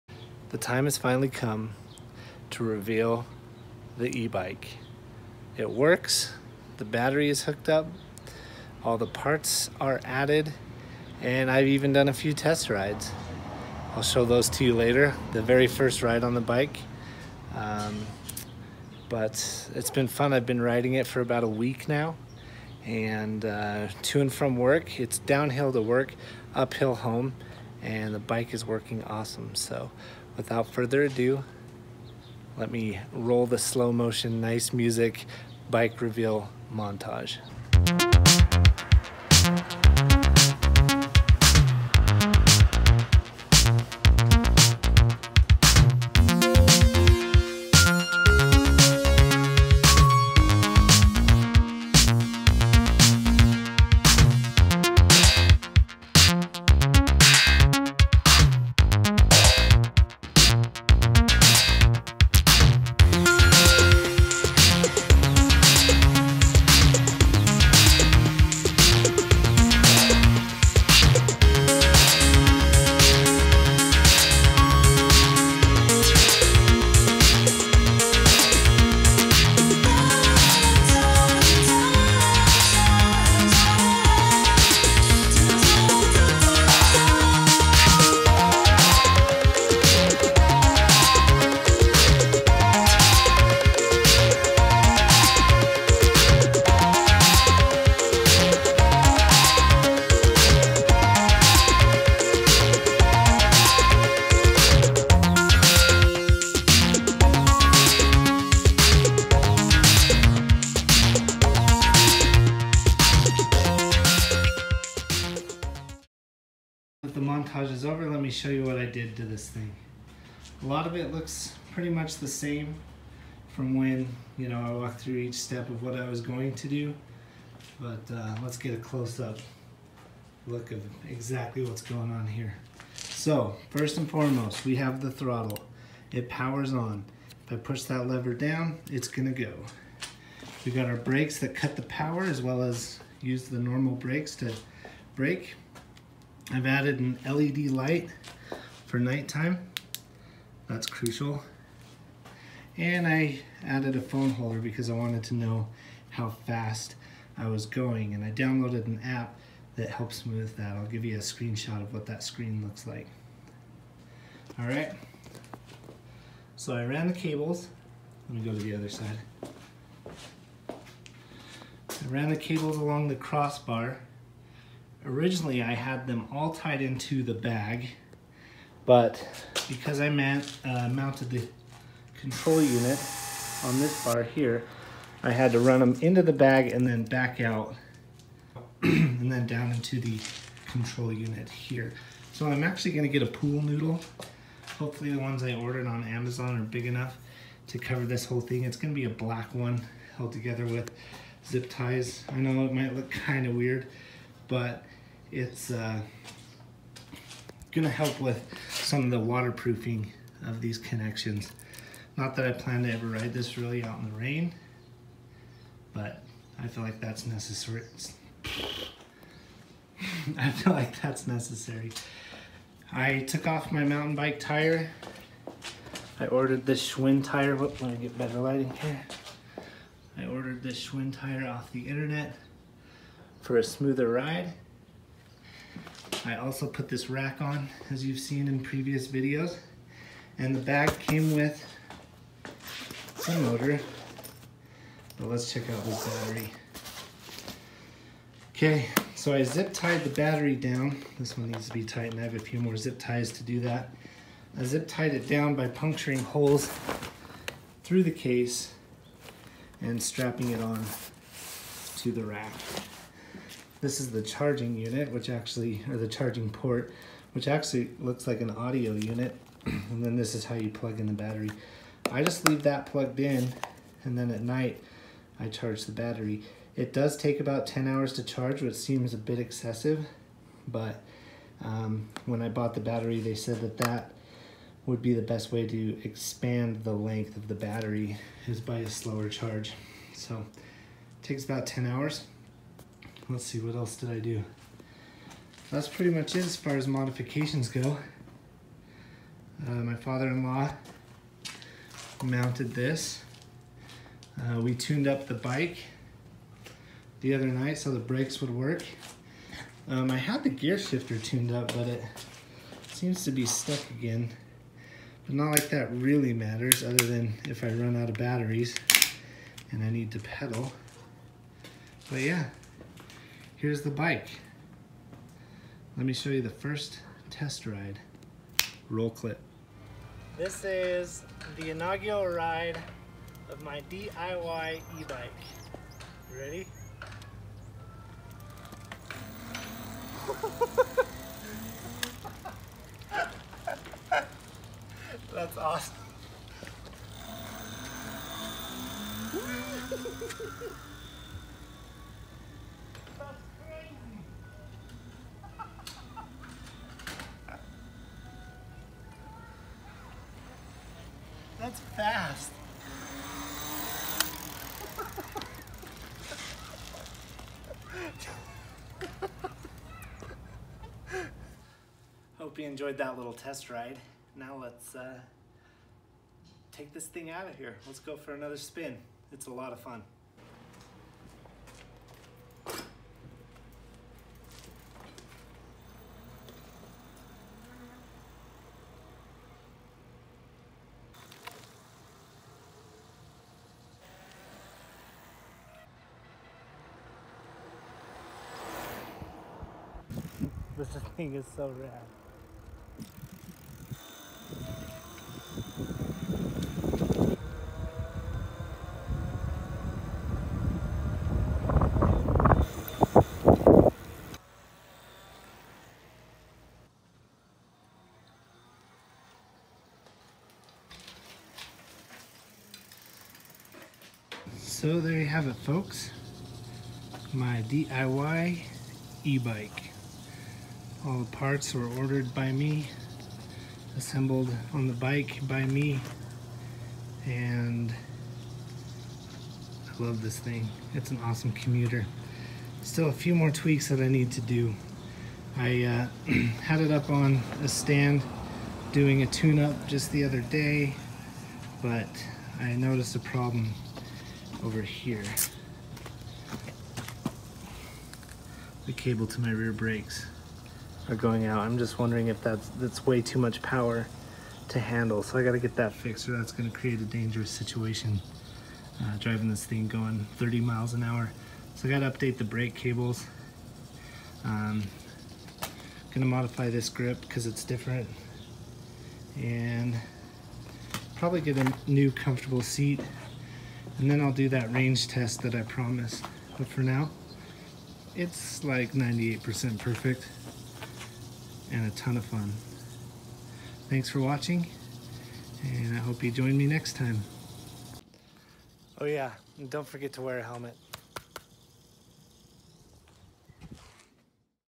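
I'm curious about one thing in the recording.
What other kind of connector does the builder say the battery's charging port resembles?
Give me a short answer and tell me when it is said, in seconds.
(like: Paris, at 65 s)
audio unit, at 268 s.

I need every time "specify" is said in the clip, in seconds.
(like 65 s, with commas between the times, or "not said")
not said.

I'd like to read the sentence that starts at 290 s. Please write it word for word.
So it takes about 10 hours let's see, what else did I do?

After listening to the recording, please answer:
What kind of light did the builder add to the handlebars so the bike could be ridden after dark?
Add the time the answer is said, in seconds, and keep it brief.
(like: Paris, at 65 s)
LED light, at 147 s.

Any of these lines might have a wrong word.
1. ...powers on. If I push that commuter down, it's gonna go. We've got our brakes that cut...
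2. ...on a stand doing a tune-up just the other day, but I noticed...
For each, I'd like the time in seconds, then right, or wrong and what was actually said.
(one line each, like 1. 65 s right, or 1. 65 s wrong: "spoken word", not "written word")
1. 136 s wrong: "lever", not "commuter"
2. 447 s right.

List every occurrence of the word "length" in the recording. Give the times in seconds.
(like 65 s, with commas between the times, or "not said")
286 s.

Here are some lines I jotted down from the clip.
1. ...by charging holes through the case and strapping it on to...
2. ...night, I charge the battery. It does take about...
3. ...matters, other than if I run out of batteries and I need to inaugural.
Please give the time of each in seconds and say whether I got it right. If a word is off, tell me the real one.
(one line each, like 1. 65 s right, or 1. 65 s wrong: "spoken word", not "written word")
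1. 255 s wrong: "puncturing", not "charging"
2. 274 s right
3. 316 s wrong: "pedal", not "inaugural".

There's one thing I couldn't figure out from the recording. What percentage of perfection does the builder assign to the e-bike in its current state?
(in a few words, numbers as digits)
98%.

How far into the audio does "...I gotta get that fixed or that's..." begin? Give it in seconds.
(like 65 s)
465 s.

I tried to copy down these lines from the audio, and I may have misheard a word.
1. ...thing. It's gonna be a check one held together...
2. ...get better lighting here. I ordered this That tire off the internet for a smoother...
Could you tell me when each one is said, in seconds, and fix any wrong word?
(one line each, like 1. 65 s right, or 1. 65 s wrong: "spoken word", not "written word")
1. 198 s wrong: "black", not "check"
2. 227 s wrong: "Schwinn", not "That".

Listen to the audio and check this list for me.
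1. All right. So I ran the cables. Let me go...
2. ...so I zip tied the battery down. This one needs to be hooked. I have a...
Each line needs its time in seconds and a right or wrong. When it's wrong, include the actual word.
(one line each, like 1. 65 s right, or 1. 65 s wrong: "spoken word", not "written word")
1. 164 s right
2. 249 s wrong: "tightened", not "hooked".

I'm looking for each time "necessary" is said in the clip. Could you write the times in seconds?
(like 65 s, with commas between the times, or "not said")
217 s, 221 s.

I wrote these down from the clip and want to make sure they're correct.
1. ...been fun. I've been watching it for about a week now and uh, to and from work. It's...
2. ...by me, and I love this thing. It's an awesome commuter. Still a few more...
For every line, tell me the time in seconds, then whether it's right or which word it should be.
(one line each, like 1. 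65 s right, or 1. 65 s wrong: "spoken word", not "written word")
1. 19 s wrong: "riding", not "watching"
2. 435 s right.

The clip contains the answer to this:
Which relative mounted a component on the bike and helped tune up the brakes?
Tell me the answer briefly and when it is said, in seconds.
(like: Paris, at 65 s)
father-in-law, at 299 s.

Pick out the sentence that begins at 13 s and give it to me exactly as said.
I'll show those to you later, the very first ride on the bike.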